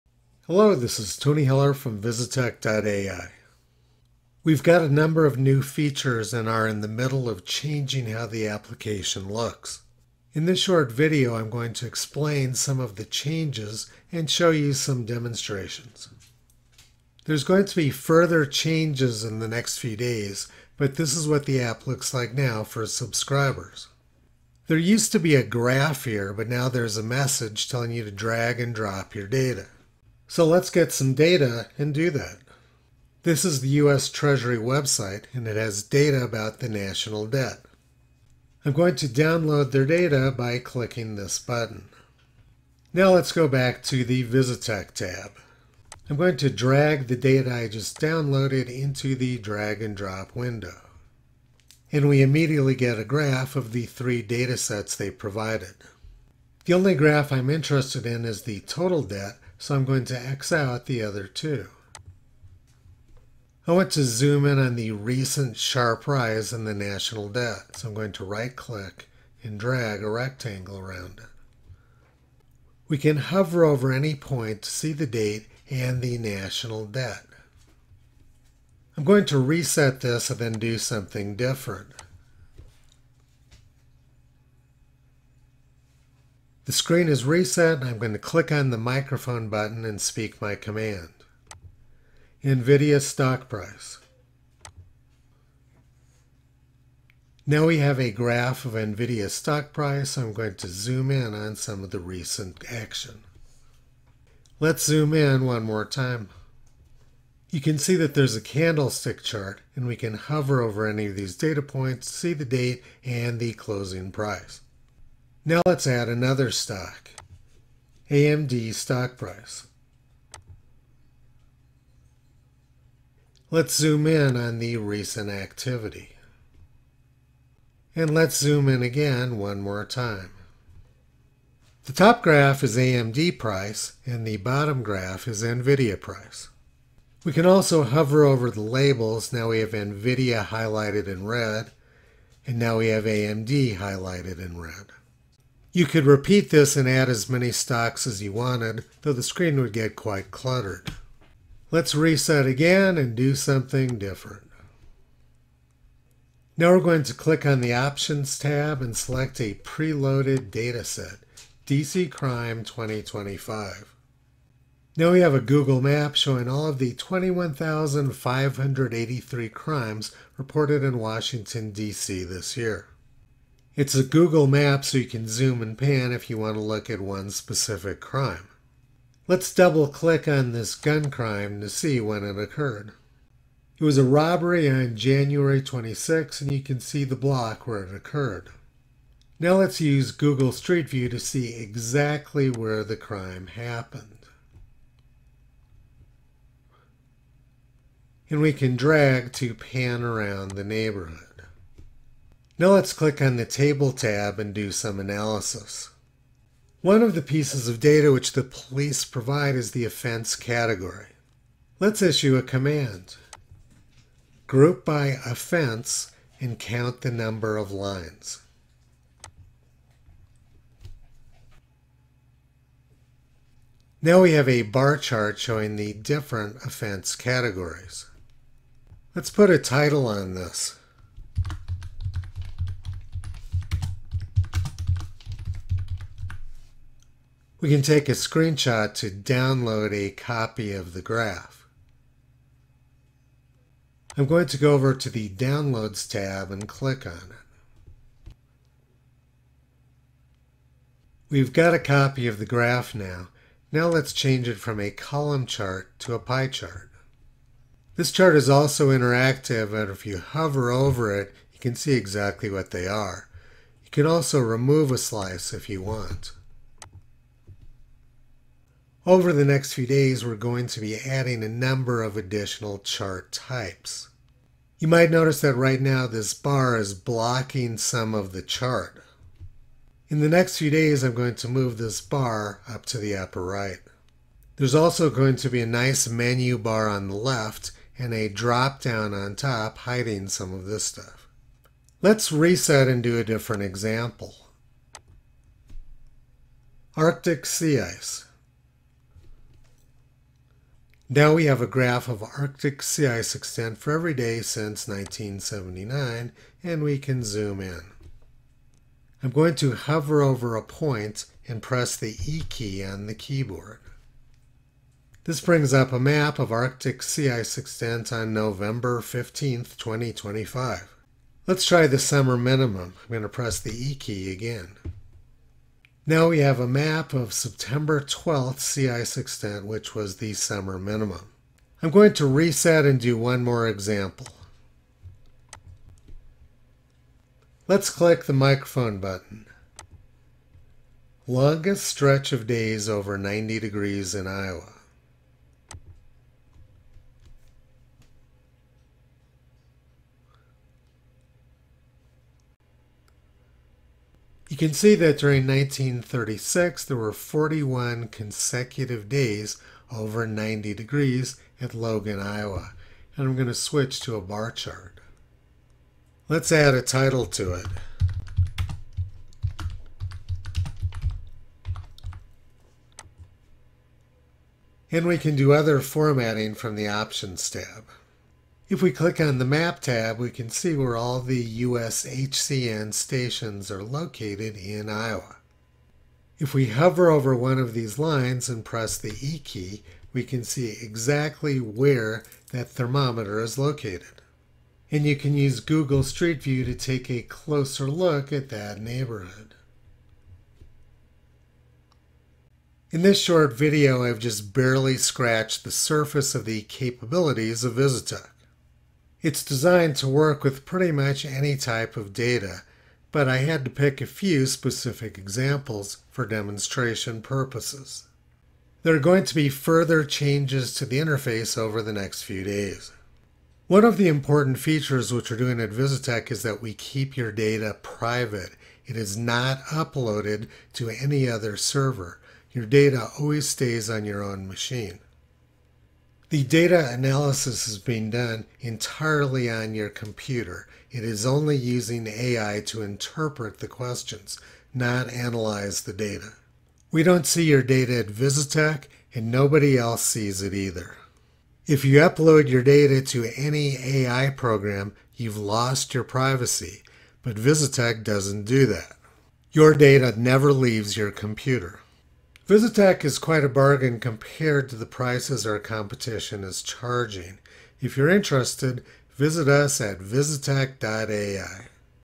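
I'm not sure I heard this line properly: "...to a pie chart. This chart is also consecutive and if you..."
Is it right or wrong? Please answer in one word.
wrong.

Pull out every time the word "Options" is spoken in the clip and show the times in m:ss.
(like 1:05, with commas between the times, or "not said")
2:37, 6:16.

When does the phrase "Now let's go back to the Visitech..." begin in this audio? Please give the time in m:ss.
0:42.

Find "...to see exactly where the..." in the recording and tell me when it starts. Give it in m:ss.
3:11.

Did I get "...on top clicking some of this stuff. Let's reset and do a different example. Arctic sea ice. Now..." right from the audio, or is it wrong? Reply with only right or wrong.
wrong.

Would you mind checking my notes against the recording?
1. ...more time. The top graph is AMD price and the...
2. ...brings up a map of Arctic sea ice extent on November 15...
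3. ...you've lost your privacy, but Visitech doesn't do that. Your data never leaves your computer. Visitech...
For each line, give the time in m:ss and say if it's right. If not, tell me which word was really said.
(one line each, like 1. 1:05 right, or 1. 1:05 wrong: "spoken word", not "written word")
1. 2:09 right
2. 5:15 right
3. 7:35 right.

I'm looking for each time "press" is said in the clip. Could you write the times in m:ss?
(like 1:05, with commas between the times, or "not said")
5:11, 5:23, 6:28.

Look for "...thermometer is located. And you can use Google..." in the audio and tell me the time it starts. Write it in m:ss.
6:32.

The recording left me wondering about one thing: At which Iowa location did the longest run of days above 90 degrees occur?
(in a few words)
Logan, Iowa.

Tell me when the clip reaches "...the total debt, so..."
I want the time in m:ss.
0:58.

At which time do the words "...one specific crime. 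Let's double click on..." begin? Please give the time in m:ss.
2:56.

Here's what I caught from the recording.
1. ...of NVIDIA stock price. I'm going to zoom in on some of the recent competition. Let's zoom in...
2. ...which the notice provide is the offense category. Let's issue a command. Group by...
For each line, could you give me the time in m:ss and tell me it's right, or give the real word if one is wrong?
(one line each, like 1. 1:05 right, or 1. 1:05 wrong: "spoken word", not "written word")
1. 1:38 wrong: "action", not "competition"
2. 3:28 wrong: "police", not "notice".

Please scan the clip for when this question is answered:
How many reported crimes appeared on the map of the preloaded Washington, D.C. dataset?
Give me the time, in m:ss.
2:46.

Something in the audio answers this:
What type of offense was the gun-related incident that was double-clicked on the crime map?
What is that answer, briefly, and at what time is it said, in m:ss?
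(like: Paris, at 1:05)
Robbery, at 3:03.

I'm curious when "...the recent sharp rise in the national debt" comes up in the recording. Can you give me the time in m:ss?
1:04.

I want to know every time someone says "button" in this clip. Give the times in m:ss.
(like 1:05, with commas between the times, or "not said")
0:41, 1:29, 5:38.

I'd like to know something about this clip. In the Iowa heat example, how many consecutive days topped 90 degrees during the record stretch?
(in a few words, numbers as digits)
41.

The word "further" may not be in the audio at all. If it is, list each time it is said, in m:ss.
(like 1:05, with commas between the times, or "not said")
0:17, 6:59.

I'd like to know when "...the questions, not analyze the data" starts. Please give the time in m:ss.
7:23.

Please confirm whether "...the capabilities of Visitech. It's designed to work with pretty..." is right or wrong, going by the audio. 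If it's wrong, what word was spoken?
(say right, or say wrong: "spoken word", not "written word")
right.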